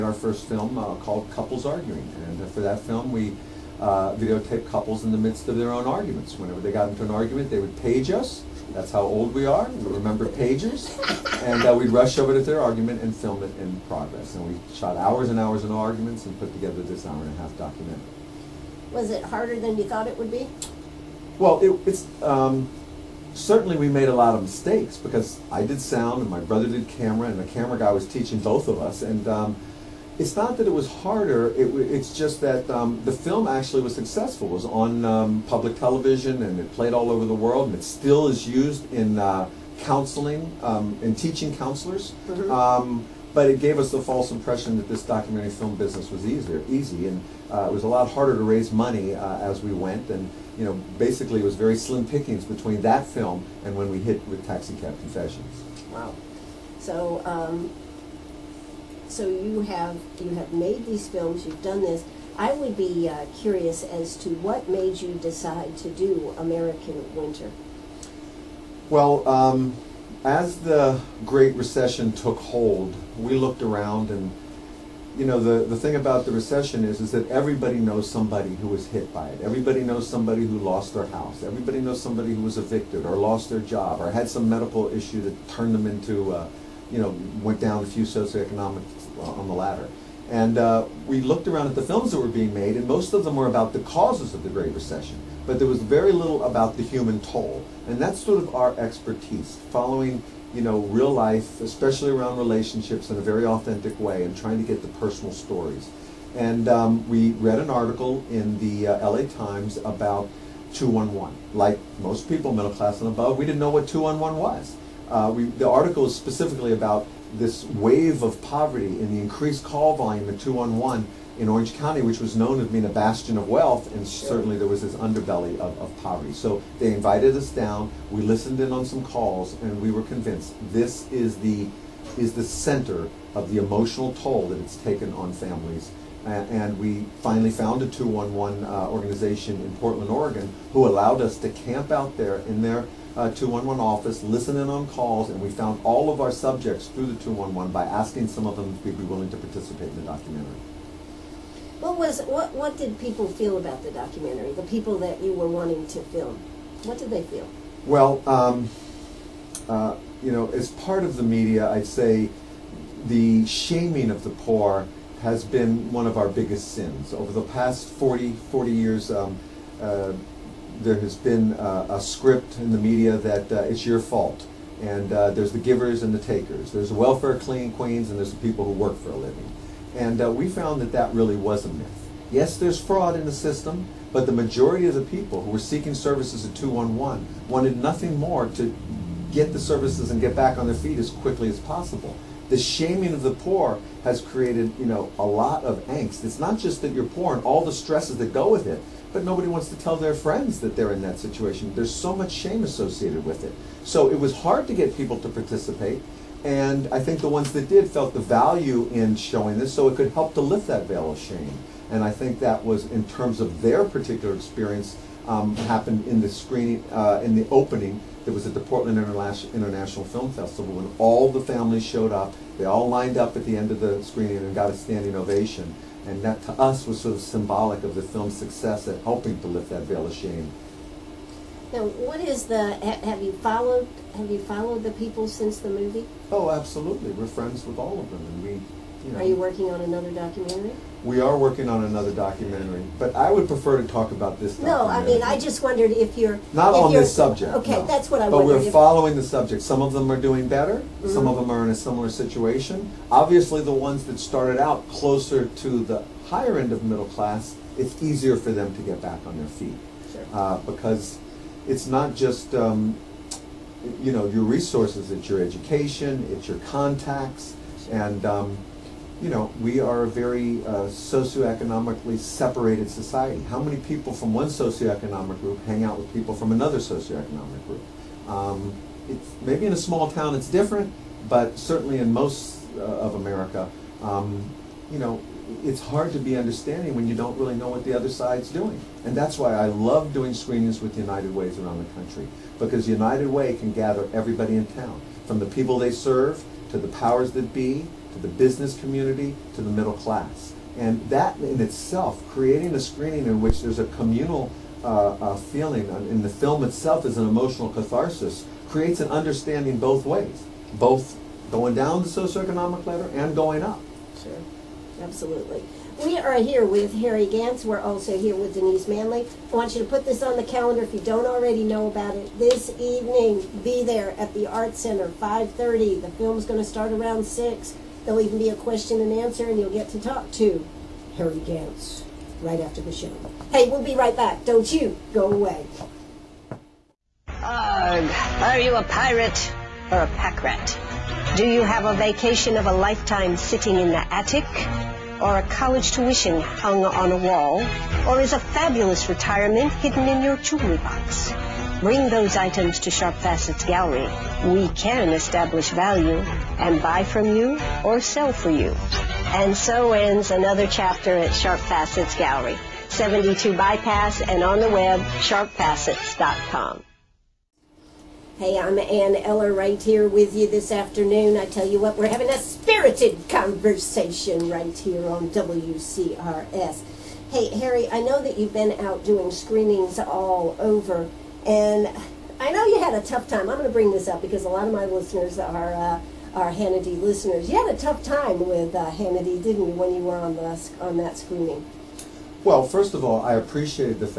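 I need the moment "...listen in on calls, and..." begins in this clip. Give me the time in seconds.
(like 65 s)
144 s.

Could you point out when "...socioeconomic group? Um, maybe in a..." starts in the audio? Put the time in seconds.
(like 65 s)
276 s.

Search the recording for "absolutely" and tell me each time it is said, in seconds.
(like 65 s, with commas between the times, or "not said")
236 s, 315 s.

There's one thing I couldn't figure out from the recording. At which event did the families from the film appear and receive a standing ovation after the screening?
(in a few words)
Portland International Film Festival.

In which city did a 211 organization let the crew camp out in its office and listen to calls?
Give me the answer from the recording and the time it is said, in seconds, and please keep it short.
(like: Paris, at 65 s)
Portland, Oregon, at 139 s.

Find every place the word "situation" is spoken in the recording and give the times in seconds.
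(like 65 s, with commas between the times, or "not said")
201 s, 252 s.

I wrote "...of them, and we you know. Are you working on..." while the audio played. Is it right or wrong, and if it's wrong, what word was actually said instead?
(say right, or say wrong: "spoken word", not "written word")
right.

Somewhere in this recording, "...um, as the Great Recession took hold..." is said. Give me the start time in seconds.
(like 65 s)
69 s.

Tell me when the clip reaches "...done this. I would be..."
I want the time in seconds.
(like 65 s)
61 s.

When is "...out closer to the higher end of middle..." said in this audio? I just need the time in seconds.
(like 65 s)
254 s.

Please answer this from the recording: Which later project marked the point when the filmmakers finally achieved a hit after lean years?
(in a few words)
Taxicab Confessions.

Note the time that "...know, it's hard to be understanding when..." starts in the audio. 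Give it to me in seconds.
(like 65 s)
284 s.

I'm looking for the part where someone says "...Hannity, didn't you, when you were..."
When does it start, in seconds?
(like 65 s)
388 s.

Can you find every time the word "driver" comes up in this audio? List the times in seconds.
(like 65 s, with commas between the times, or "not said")
not said.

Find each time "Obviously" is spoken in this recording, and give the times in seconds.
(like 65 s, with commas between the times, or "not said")
253 s.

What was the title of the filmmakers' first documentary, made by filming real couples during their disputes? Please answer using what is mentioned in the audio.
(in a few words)
Couples Arguing.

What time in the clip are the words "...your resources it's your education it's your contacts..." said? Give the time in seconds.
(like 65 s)
264 s.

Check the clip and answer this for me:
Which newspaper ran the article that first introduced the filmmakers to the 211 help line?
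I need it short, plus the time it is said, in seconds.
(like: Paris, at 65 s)
LA Times, at 109 s.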